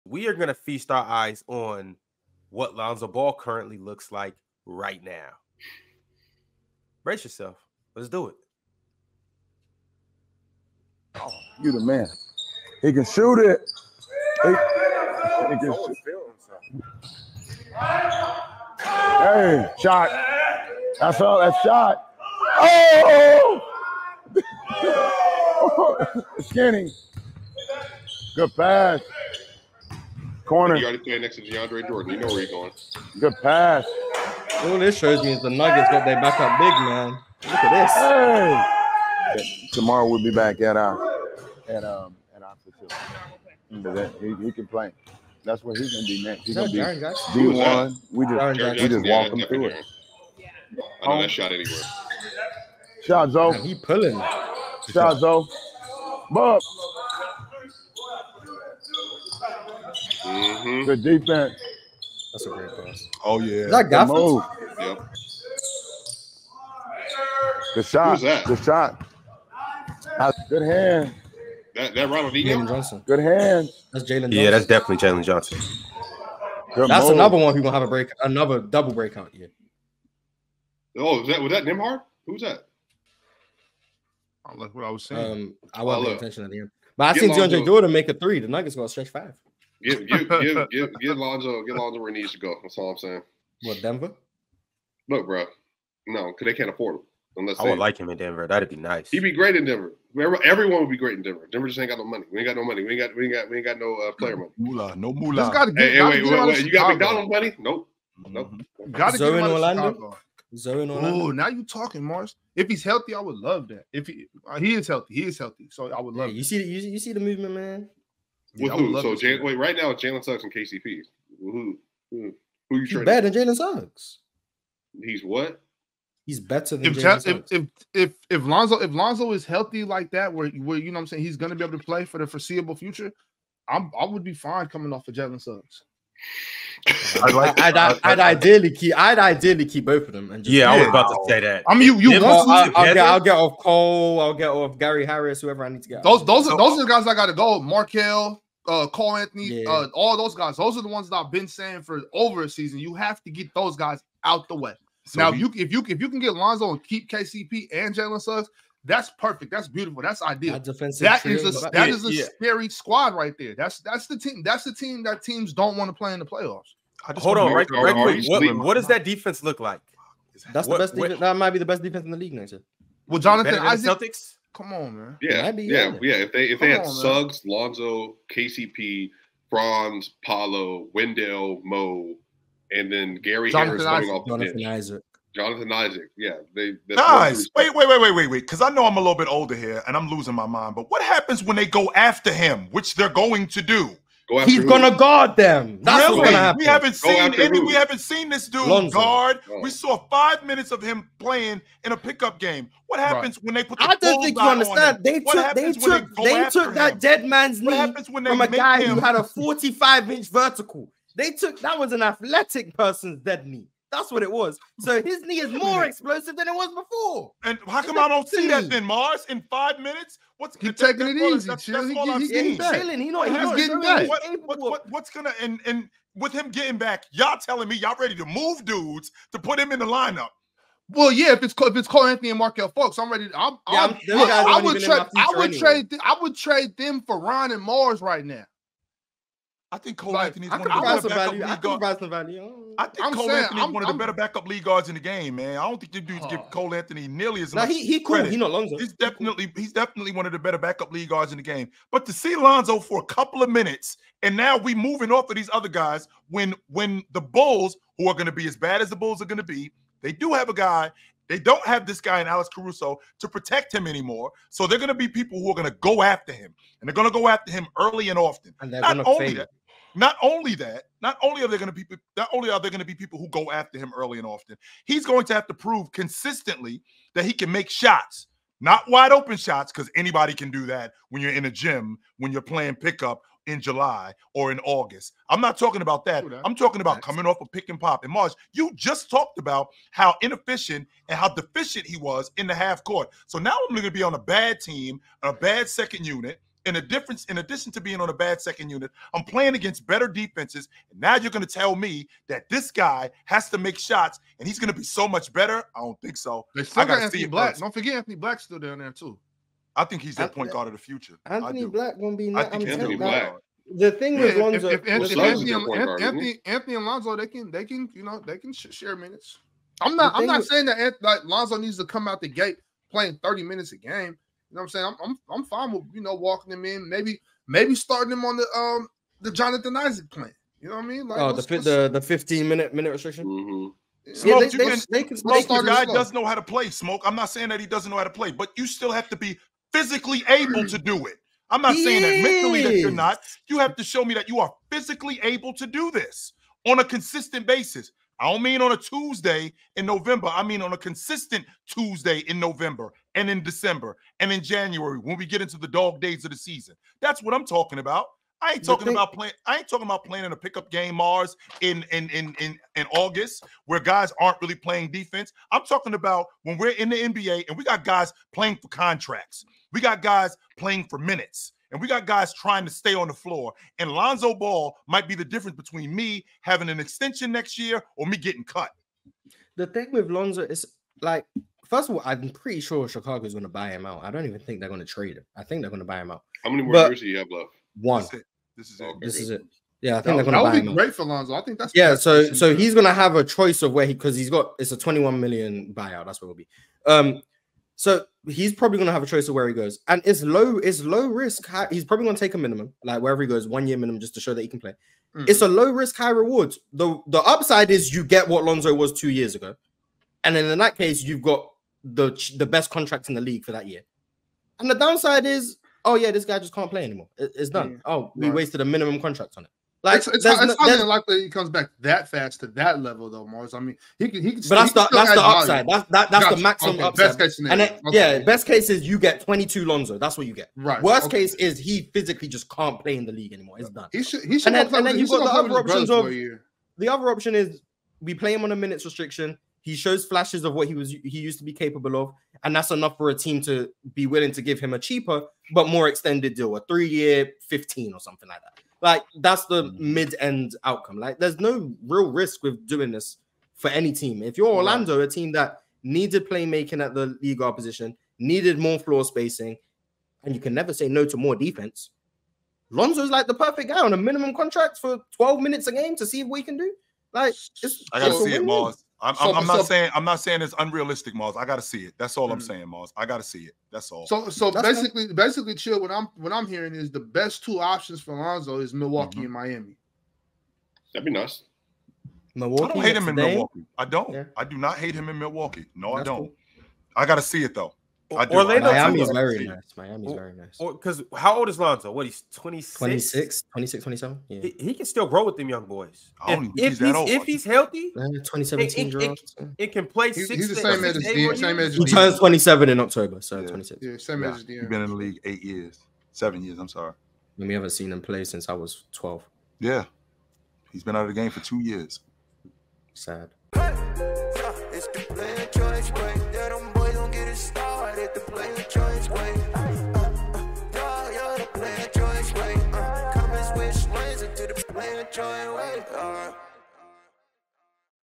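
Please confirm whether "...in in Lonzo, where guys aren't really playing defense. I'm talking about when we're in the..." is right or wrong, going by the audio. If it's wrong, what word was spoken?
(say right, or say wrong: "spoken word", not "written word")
wrong: "August", not "Lonzo".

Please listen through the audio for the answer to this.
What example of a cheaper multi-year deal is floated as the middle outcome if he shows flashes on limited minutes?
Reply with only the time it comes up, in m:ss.
7:26.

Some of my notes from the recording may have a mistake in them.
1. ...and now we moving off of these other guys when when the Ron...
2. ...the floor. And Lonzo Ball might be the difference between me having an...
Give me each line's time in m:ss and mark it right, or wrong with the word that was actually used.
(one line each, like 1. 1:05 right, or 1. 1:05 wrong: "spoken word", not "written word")
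1. 4:14 wrong: "Bulls", not "Ron"
2. 6:13 right.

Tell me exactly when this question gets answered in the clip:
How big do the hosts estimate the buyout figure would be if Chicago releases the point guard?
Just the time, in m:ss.
6:34.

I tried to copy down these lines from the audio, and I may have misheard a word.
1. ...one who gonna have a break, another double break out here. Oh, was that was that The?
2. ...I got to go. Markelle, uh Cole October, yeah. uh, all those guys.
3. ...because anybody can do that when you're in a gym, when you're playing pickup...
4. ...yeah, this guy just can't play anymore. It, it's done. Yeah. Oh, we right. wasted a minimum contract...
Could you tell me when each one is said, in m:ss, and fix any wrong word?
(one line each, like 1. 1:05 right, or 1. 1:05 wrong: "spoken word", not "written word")
1. 1:17 wrong: "Nembhard", not "The"
2. 2:27 wrong: "Anthony", not "October"
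3. 4:39 right
4. 6:55 right.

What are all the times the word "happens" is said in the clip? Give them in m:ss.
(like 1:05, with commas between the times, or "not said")
3:11, 3:16, 3:22.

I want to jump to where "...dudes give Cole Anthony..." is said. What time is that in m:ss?
4:06.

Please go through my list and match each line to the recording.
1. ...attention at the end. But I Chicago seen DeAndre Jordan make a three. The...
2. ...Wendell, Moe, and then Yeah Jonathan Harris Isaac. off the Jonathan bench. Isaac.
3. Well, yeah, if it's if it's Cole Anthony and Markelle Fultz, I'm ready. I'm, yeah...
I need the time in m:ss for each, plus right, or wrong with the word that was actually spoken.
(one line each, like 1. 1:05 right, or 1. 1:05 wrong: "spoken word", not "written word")
1. 1:26 wrong: "Get", not "Chicago"
2. 3:00 wrong: "Gary", not "Yeah"
3. 3:50 right.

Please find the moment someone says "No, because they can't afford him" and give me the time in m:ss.
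1:36.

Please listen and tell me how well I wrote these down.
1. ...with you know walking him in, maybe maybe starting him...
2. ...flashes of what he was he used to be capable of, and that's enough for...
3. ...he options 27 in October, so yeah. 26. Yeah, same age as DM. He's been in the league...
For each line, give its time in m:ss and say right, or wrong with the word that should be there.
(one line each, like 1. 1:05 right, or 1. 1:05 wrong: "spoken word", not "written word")
1. 5:25 right
2. 7:20 right
3. 8:21 wrong: "turns", not "options".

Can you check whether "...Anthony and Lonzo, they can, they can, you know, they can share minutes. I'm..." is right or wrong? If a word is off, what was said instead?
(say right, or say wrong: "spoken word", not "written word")
right.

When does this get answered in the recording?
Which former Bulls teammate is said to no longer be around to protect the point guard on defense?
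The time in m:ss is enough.
4:21.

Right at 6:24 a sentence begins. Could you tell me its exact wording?
I don't even think they're going to trade him.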